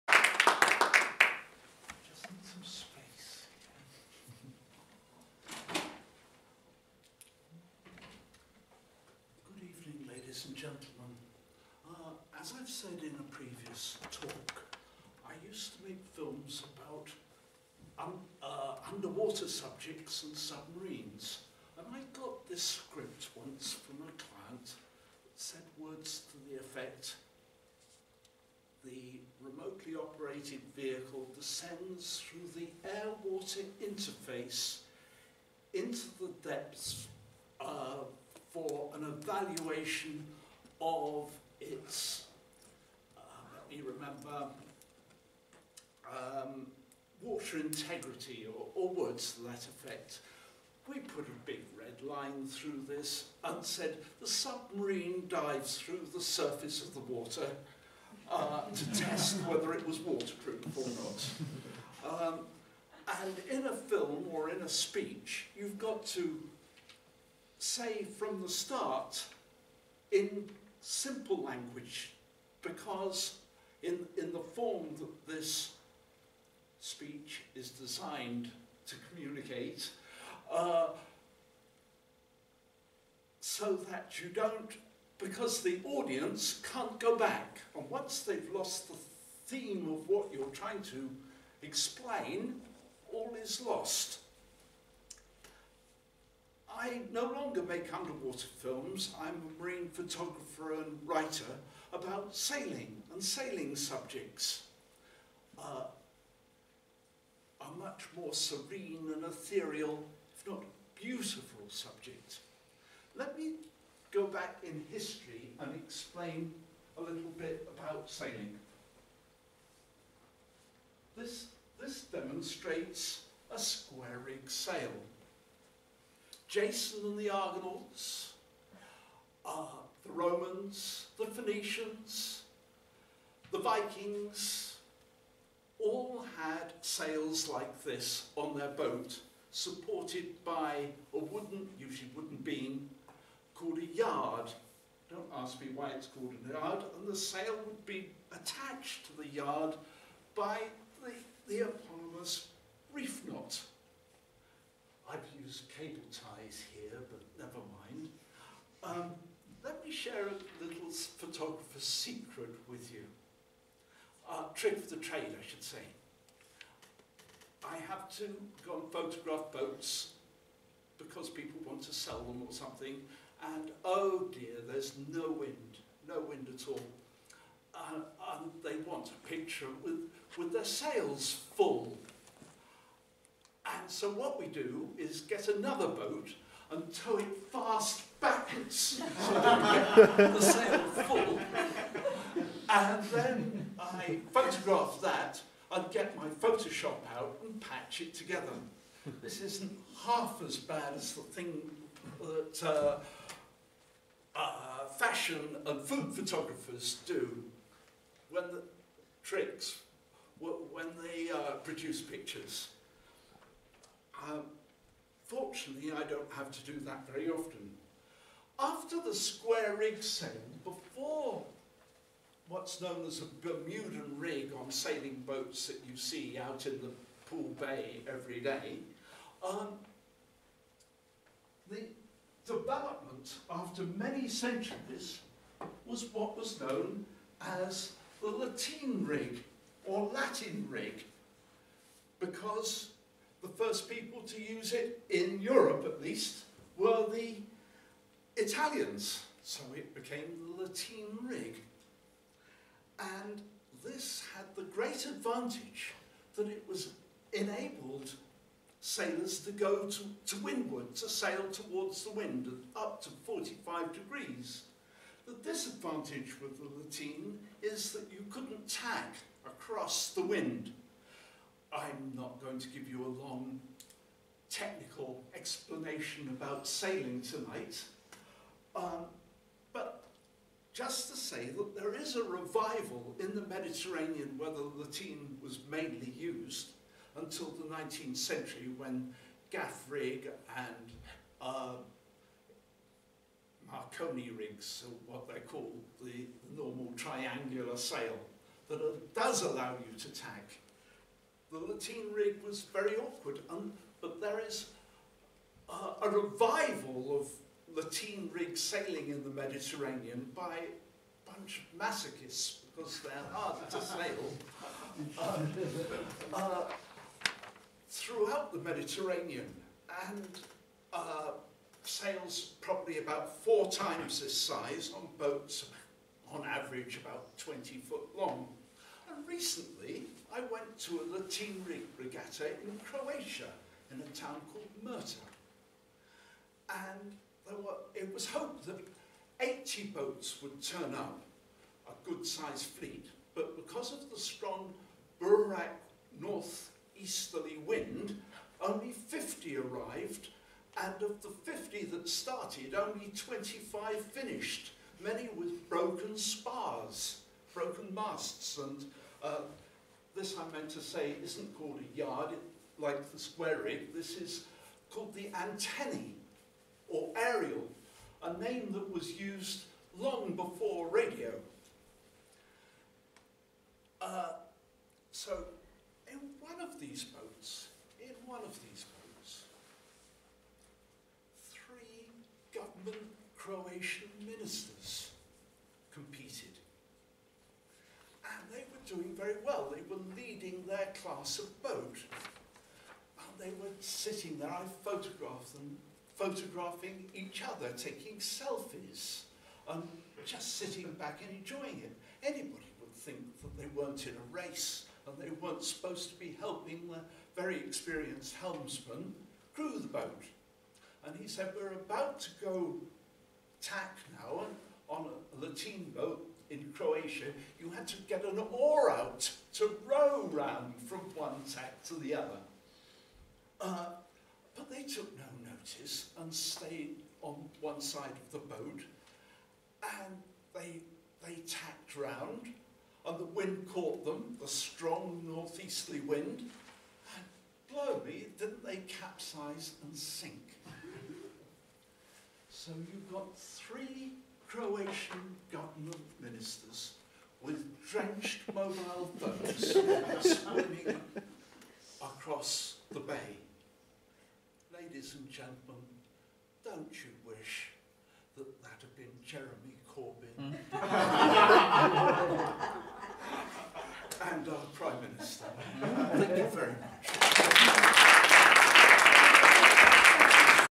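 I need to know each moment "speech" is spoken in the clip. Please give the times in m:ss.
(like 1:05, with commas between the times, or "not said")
1:04, 1:16.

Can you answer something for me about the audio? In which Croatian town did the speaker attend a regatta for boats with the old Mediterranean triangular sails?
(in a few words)
Murter.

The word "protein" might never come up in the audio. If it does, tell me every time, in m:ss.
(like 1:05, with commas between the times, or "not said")
not said.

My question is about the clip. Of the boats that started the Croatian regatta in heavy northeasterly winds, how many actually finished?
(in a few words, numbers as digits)
25.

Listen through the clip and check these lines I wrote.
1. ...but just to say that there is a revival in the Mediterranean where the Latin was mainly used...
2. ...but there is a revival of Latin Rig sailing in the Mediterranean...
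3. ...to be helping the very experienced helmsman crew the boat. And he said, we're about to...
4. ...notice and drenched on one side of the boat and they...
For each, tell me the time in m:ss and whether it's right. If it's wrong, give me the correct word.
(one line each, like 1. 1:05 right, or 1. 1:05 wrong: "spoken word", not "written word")
1. 4:39 right
2. 5:03 right
3. 6:46 right
4. 7:05 wrong: "stayed", not "drenched".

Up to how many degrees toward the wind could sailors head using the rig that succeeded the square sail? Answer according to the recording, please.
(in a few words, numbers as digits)
45 degrees.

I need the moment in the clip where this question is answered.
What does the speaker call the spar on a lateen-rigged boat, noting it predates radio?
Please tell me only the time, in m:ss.
6:05.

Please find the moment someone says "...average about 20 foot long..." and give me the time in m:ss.
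5:26.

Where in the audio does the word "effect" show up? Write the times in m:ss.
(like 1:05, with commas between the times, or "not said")
0:26, 0:49.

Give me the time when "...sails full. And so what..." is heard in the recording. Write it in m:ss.
3:00.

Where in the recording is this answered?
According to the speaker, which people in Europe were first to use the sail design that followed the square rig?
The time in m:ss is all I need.
4:07.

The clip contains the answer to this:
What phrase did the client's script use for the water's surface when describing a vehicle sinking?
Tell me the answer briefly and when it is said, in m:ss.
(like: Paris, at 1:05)
air-water interface, at 0:32.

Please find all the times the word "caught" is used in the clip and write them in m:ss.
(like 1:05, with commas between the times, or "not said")
7:13.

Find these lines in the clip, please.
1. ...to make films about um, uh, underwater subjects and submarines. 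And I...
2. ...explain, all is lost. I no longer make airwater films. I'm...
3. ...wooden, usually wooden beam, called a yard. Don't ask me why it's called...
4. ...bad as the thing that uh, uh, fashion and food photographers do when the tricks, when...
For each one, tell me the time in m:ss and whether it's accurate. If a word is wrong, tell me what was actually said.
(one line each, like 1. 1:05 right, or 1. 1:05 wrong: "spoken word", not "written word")
1. 0:15 right
2. 1:31 wrong: "underwater", not "airwater"
3. 2:21 right
4. 3:20 right.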